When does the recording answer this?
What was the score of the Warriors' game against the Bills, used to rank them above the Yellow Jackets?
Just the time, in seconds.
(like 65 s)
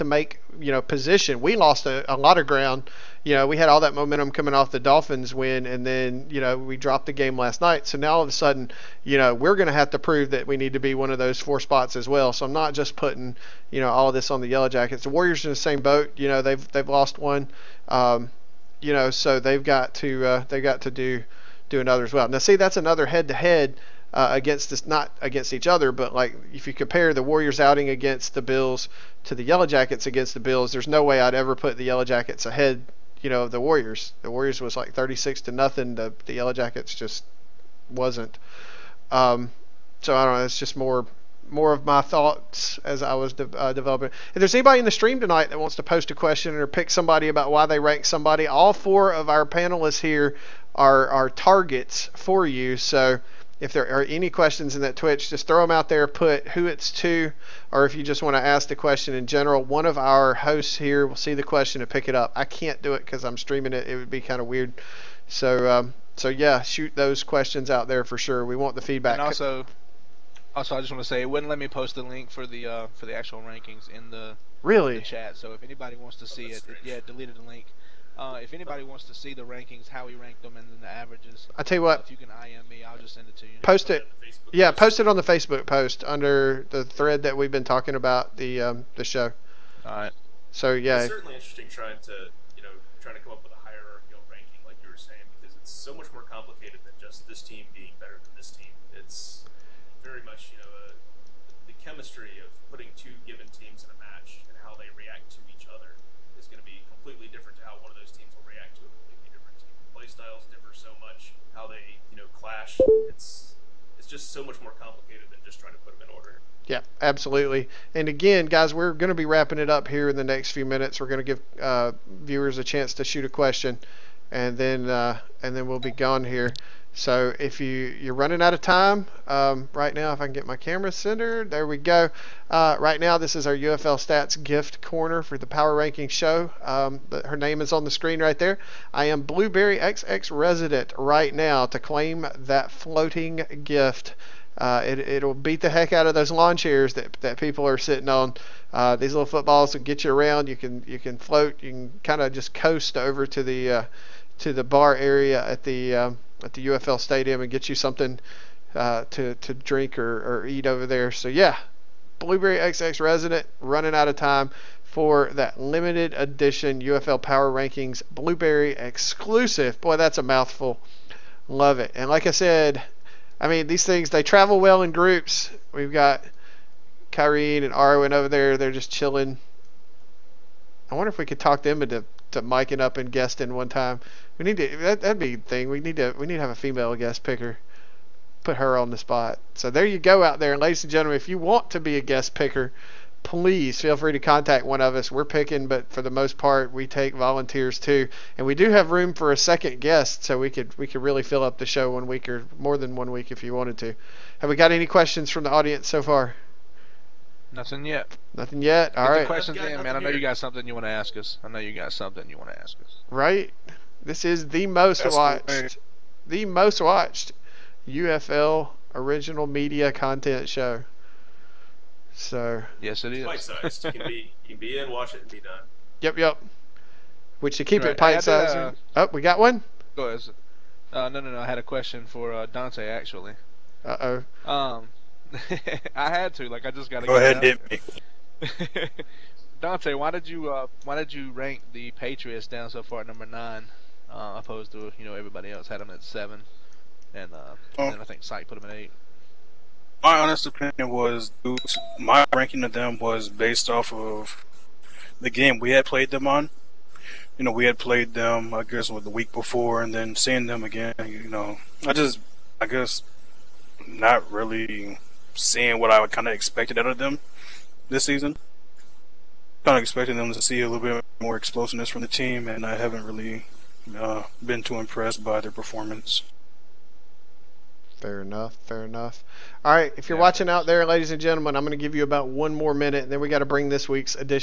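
34 s.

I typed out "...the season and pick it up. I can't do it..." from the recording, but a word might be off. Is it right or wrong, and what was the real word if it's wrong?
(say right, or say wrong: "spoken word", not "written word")
wrong: "question", not "season".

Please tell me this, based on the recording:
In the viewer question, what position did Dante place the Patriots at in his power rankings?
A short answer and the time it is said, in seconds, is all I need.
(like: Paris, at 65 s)
9, at 243 s.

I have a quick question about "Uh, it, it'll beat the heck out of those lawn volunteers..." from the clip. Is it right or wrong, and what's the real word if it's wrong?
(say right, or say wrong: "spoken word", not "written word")
wrong: "chairs", not "volunteers".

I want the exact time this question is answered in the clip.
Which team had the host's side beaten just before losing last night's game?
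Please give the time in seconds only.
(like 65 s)
4 s.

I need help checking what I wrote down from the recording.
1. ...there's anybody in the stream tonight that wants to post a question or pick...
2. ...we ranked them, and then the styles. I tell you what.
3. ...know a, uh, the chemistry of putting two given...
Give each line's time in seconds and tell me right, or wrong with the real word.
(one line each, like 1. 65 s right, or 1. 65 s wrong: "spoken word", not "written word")
1. 44 s right
2. 80 s wrong: "averages", not "styles"
3. 100 s right.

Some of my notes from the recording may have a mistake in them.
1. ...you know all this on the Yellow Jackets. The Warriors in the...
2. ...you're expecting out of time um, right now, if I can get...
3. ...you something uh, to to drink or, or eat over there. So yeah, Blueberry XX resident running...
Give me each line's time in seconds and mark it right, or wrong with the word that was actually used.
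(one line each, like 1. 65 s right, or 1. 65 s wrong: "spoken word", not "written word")
1. 13 s right
2. 127 s wrong: "running", not "expecting"
3. 157 s right.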